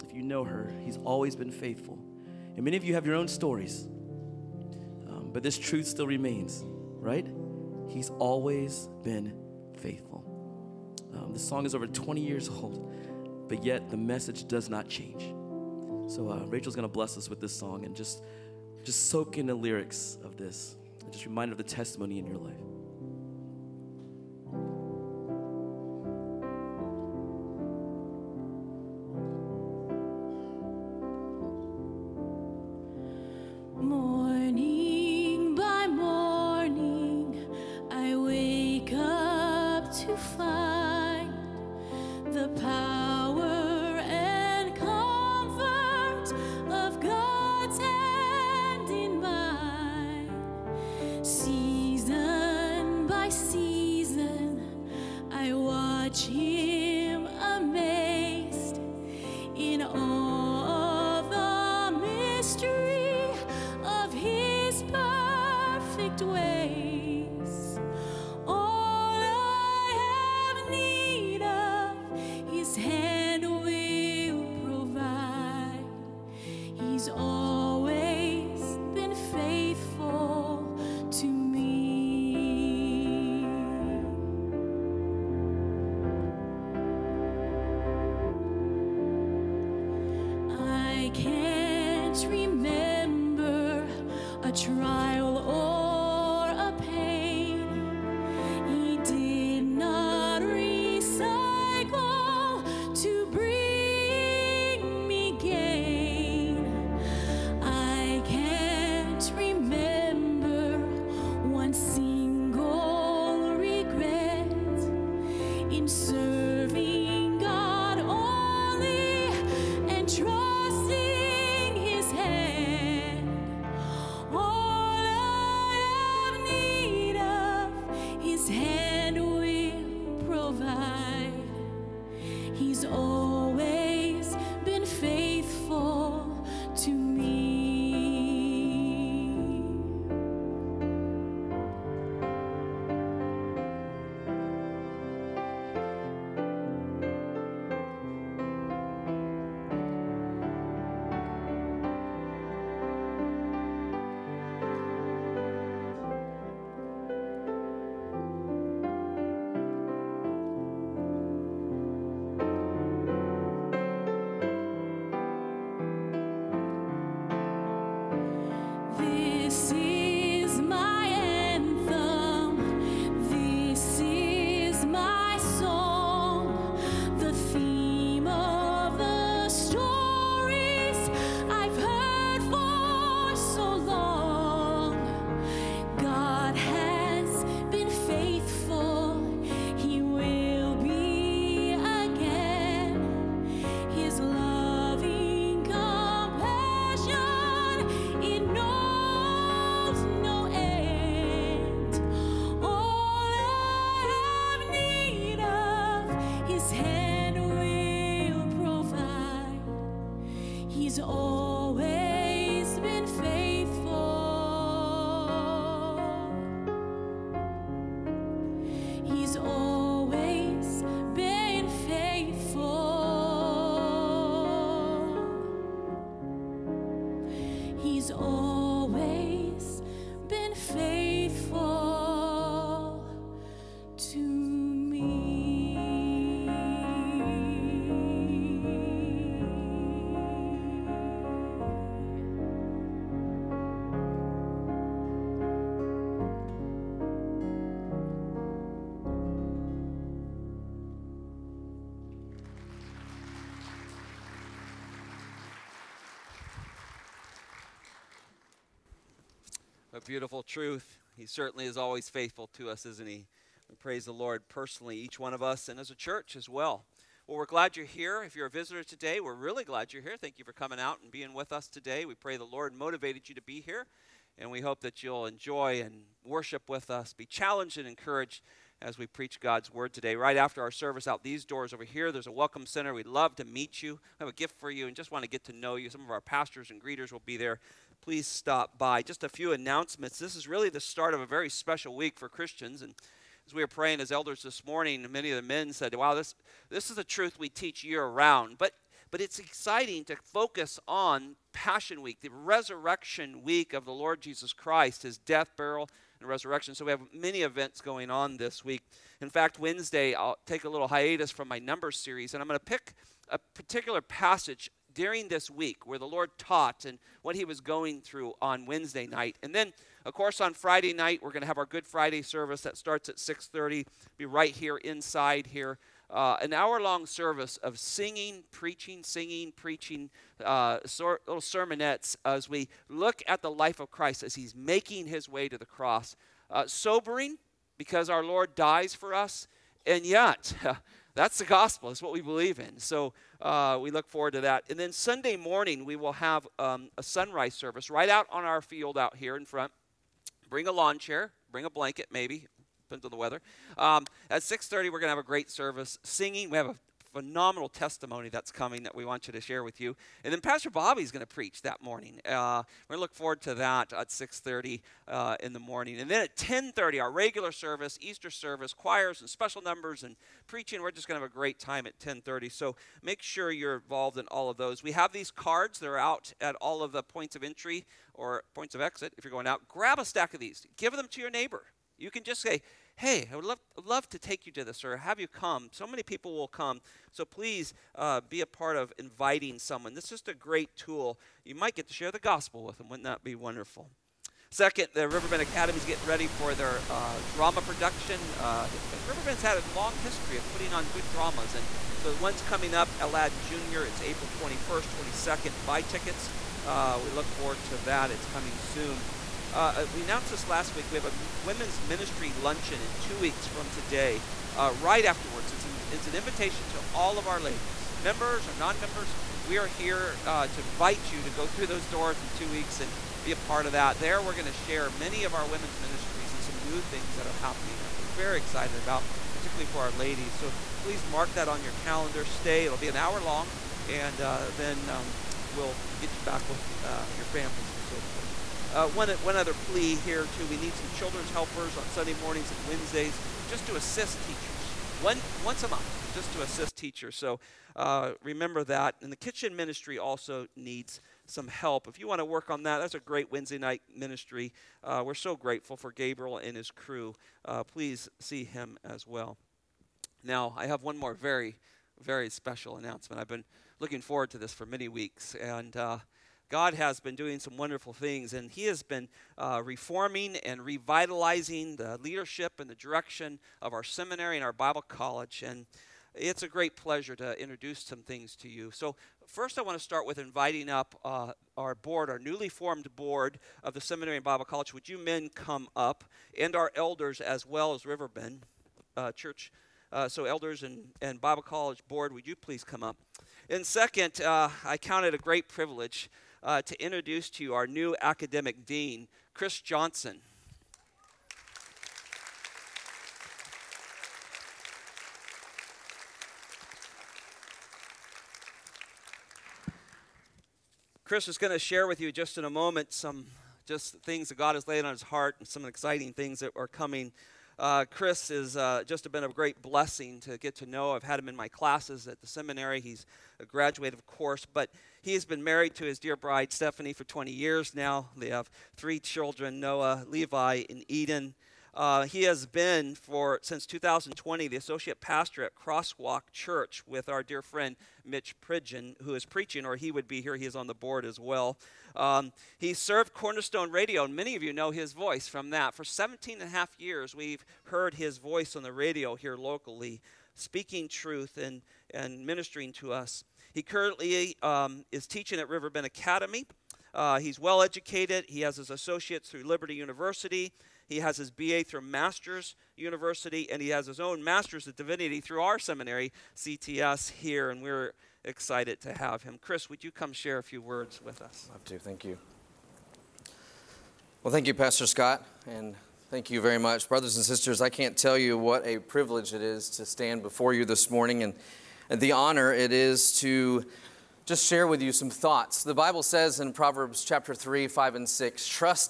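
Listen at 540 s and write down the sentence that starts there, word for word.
He is on the board as well.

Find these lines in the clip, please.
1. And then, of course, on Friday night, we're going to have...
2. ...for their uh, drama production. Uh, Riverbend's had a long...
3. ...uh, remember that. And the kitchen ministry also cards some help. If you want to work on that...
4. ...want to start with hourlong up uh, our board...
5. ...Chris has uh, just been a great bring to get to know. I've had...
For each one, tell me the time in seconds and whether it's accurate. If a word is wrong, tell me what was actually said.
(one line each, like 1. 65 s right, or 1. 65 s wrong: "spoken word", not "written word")
1. 319 s right
2. 396 s right
3. 447 s wrong: "needs", not "cards"
4. 479 s wrong: "inviting", not "hourlong"
5. 517 s wrong: "blessing", not "bring".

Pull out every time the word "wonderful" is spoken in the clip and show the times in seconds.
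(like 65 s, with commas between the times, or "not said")
393 s, 467 s.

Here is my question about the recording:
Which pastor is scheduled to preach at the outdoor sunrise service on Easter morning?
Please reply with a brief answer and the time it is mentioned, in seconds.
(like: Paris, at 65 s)
Pastor Bobby, at 360 s.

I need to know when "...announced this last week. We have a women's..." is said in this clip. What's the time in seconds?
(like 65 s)
410 s.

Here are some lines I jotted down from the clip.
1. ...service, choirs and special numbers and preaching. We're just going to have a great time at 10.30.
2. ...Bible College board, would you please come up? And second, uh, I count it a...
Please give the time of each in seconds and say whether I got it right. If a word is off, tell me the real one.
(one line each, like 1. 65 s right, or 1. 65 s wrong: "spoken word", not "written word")
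1. 368 s right
2. 491 s right.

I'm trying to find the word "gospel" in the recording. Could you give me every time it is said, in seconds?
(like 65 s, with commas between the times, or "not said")
341 s, 392 s.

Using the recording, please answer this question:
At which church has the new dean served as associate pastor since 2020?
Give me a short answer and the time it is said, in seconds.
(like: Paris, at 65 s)
Crosswalk Church, at 535 s.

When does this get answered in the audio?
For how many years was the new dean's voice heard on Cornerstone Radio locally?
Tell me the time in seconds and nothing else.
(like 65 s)
545 s.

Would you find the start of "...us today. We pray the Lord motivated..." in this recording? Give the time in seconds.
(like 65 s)
271 s.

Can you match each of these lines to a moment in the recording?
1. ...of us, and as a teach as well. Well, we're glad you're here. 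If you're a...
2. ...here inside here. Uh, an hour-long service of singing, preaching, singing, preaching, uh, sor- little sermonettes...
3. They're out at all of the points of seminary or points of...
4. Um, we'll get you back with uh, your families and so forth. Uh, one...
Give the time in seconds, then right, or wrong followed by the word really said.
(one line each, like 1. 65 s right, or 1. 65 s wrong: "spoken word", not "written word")
1. 265 s wrong: "church", not "teach"
2. 324 s right
3. 375 s wrong: "entry", not "seminary"
4. 434 s right.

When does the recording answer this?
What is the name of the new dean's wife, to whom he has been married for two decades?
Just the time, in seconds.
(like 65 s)
526 s.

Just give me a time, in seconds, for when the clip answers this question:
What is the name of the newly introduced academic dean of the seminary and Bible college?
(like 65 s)
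499 s.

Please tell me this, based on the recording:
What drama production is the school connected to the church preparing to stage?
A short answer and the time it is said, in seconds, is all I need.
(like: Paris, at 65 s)
Aladdin Jr., at 402 s.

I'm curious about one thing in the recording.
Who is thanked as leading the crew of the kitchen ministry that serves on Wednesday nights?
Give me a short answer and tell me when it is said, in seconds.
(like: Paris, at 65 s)
Gabriel, at 455 s.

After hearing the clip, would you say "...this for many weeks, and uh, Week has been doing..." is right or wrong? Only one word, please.
wrong.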